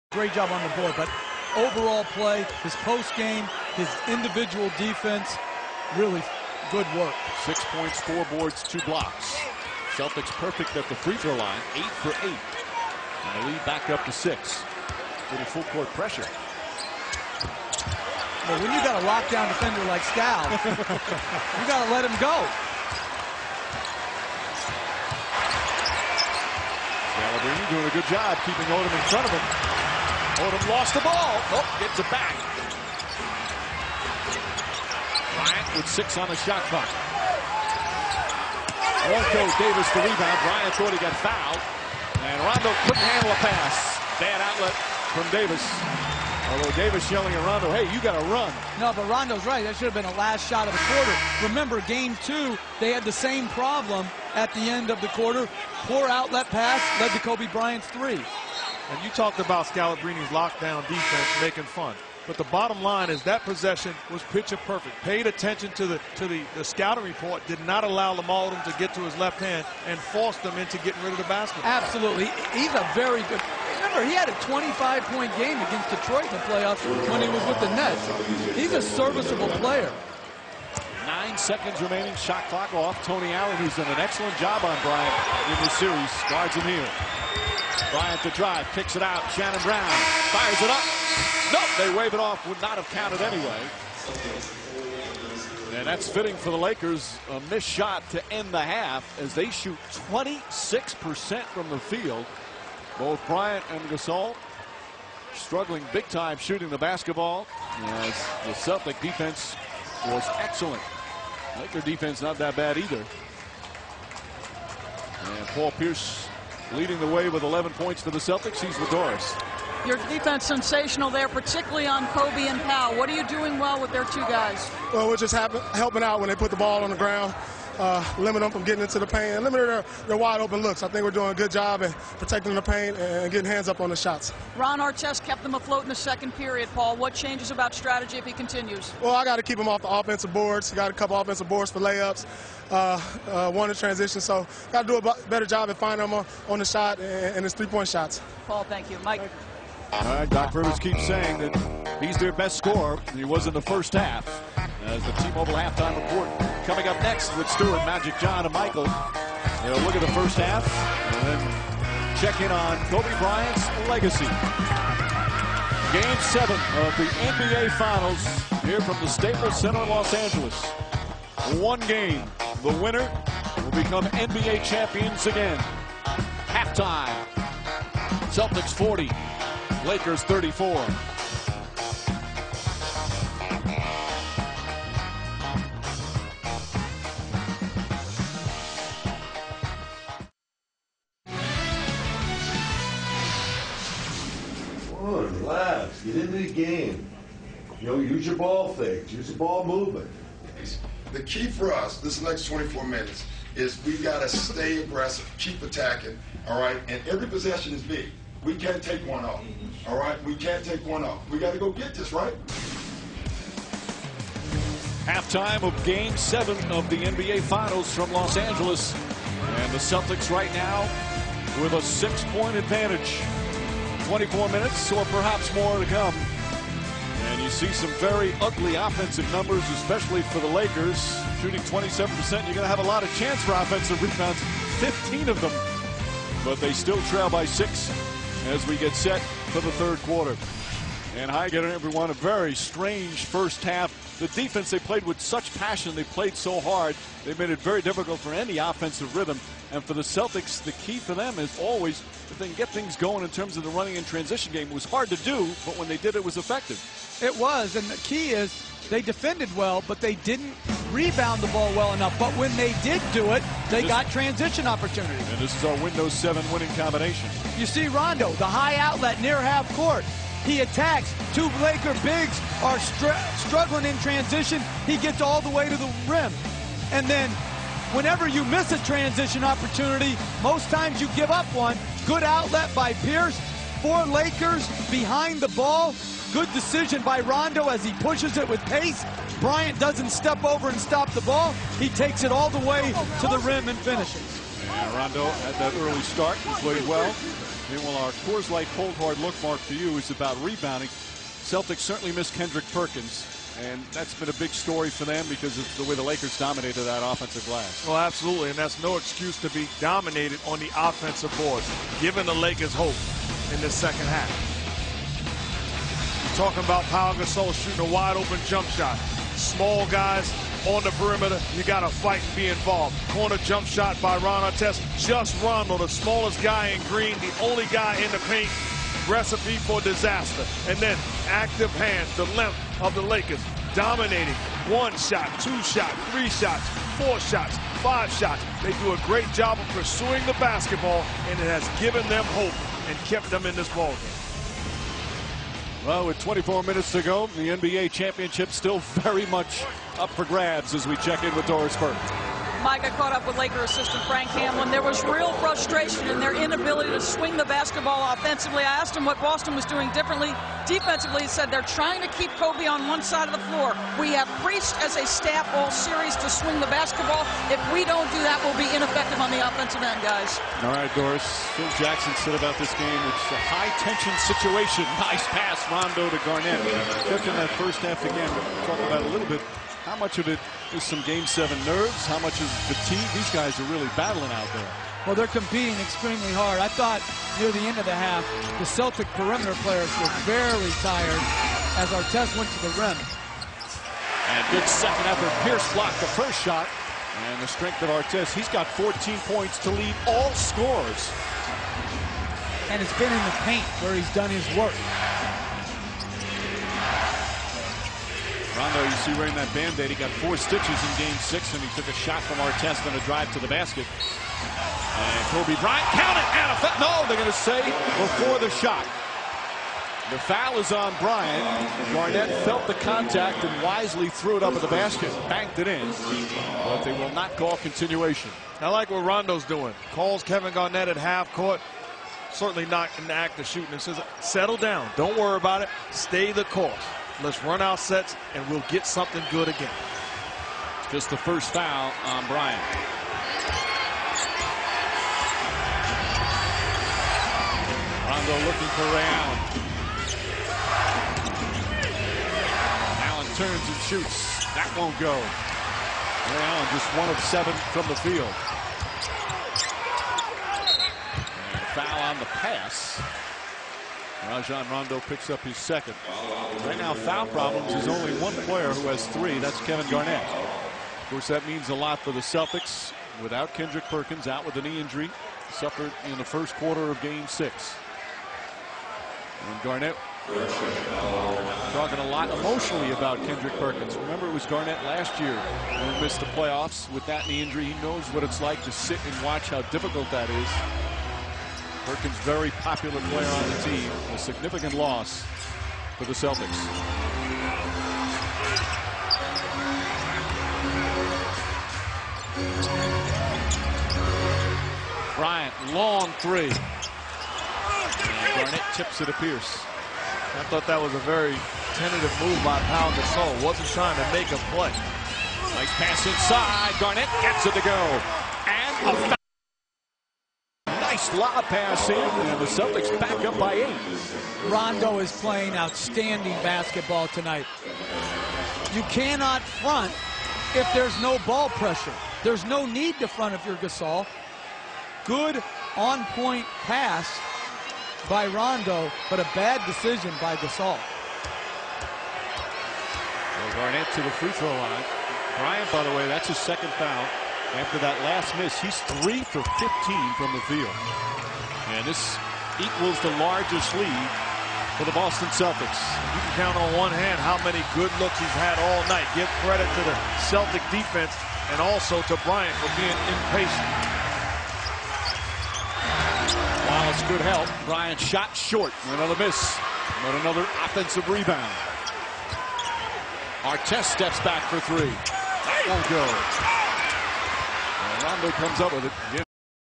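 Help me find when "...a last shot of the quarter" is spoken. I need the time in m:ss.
0:50.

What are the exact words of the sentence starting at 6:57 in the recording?
No, they're going to say before the shot.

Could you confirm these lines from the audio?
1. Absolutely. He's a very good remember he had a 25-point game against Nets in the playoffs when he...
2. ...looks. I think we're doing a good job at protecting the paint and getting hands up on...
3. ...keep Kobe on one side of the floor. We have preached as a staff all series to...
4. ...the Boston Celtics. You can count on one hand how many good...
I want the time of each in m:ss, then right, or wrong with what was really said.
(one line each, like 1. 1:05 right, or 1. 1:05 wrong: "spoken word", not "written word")
1. 1:11 wrong: "Detroit", not "Nets"
2. 2:10 right
3. 6:02 right
4. 9:14 right.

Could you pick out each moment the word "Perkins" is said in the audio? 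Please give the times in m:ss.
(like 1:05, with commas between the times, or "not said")
5:02, 7:53, 8:03, 8:11.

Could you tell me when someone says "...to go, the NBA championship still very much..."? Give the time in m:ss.
5:46.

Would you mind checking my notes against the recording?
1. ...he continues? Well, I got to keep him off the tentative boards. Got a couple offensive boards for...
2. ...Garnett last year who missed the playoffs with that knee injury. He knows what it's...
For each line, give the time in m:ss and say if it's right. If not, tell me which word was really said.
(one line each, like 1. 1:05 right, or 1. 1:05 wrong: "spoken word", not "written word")
1. 2:18 wrong: "offensive", not "tentative"
2. 8:04 right.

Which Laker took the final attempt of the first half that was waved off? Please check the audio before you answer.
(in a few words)
Shannon Brown.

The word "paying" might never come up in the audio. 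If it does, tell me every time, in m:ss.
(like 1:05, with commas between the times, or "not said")
not said.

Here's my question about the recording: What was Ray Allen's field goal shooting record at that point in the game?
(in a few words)
1 of 7.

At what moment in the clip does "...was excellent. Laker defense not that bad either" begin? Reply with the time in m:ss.
1:50.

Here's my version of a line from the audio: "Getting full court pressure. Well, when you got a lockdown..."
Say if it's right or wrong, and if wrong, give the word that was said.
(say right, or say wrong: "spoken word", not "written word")
right.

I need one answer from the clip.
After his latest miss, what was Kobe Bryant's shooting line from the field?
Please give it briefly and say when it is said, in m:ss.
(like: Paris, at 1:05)
3 for 15, at 9:09.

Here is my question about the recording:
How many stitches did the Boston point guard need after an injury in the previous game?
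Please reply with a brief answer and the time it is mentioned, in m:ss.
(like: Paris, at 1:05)
4, at 6:50.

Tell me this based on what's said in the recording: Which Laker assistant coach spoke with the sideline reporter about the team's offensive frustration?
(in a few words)
Frank Hamblen.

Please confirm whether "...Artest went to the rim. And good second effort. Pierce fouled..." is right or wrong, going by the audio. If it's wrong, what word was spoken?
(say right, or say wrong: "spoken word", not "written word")
wrong: "blocked", not "fouled".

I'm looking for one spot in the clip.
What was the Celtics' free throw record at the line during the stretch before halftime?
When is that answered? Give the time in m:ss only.
0:11.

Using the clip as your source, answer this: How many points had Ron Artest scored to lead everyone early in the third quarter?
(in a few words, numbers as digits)
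14.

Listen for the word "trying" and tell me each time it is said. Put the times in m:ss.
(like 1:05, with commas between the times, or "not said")
6:01, 8:33.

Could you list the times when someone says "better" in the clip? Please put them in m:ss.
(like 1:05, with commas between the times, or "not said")
2:25.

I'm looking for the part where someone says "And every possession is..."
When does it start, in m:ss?
3:26.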